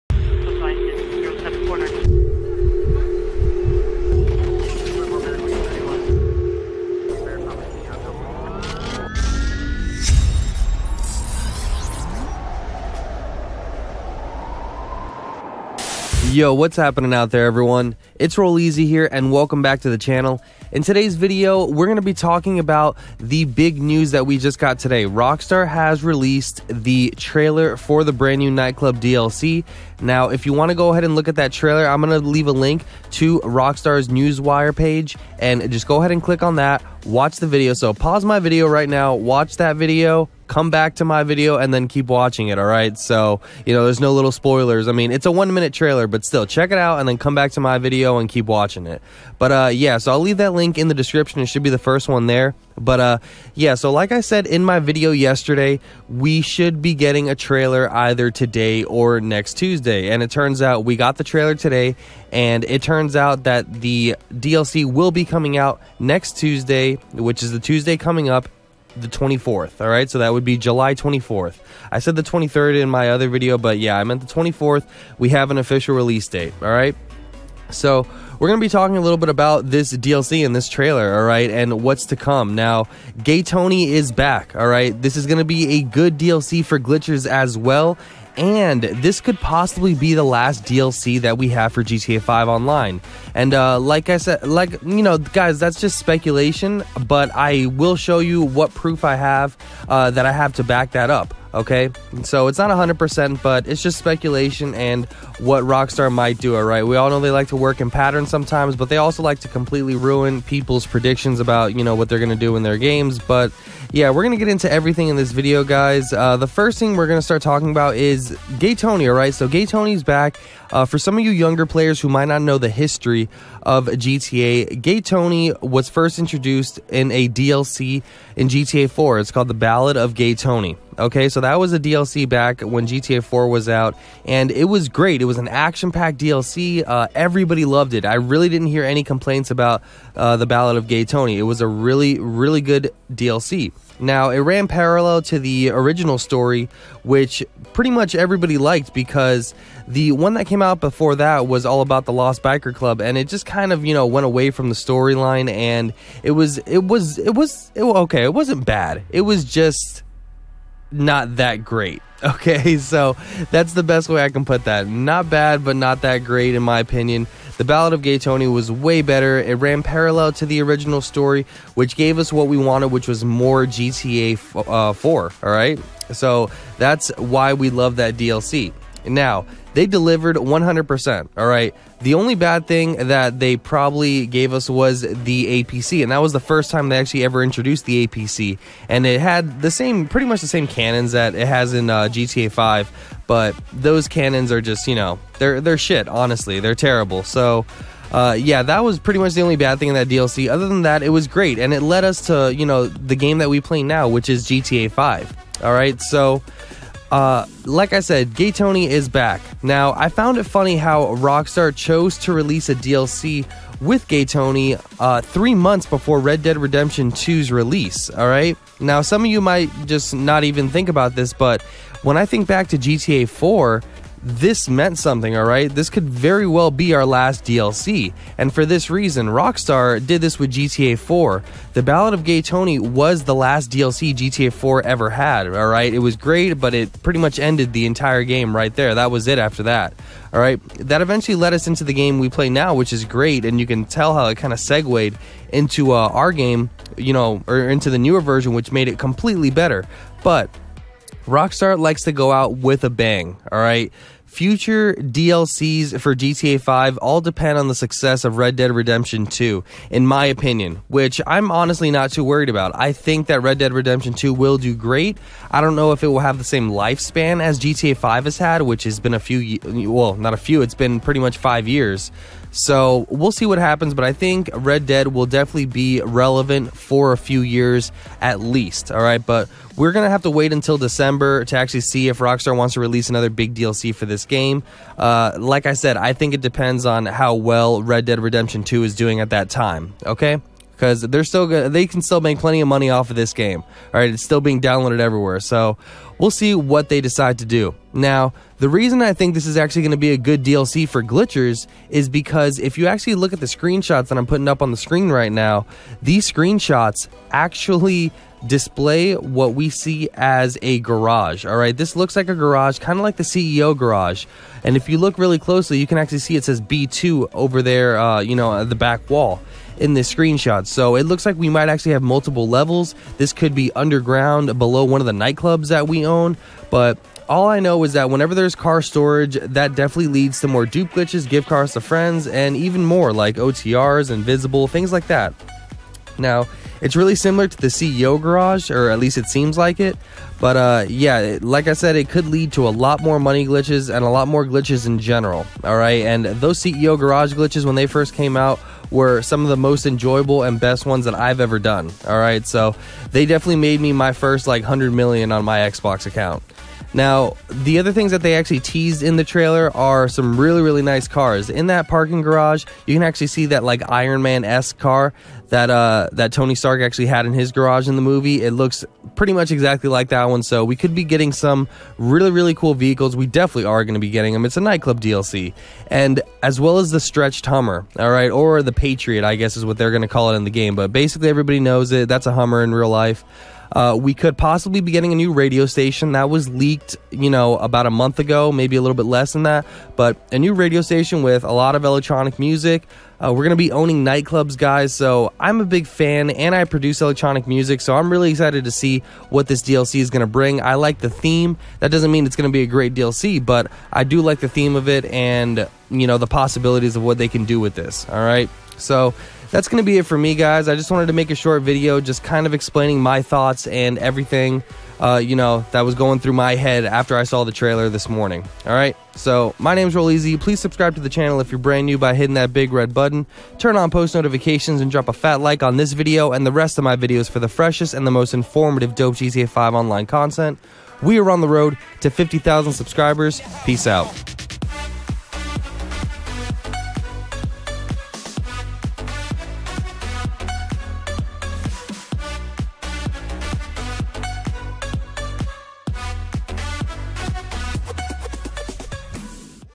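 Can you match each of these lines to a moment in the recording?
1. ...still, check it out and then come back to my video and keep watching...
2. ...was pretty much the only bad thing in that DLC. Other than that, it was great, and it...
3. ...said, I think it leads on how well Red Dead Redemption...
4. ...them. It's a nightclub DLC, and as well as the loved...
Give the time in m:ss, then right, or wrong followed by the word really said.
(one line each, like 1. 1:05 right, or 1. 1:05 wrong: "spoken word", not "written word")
1. 0:46 right
2. 3:18 right
3. 4:45 wrong: "depends", not "leads"
4. 6:14 wrong: "stretched", not "loved".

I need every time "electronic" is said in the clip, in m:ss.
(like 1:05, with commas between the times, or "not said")
6:31, 6:37.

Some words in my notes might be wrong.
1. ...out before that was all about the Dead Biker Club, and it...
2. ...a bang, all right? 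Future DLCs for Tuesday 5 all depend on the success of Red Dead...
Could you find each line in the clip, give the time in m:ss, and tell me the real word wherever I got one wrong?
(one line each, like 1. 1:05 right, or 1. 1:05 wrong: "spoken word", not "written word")
1. 2:30 wrong: "Lost", not "Dead"
2. 4:12 wrong: "GTA", not "Tuesday".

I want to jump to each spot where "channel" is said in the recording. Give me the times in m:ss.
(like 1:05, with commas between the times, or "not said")
0:19, 7:01.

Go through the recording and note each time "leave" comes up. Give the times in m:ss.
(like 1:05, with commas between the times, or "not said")
0:32, 0:50.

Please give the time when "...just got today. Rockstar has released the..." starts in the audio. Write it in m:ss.
0:24.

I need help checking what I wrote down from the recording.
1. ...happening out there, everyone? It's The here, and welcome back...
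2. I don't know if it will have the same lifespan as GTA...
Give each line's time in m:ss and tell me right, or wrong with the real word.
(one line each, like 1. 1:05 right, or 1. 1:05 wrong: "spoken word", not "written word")
1. 0:16 wrong: "Rolleezy", not "The"
2. 4:25 right.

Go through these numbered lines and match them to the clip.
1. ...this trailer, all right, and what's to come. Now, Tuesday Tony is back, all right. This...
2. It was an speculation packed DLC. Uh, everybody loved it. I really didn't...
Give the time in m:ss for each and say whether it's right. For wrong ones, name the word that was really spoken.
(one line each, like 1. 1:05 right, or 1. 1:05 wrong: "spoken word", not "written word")
1. 1:20 wrong: "Gay", not "Tuesday"
2. 2:15 wrong: "action", not "speculation".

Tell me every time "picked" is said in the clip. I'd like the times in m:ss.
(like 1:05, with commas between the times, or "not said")
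not said.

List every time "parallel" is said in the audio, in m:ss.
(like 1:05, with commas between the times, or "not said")
2:24, 2:49.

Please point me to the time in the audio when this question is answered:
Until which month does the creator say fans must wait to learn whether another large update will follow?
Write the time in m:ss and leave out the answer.
4:40.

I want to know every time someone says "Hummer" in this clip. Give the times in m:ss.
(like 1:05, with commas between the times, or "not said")
6:17, 6:22.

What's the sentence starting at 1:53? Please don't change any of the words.
But yeah, we're gonna get into everything in this video, guys.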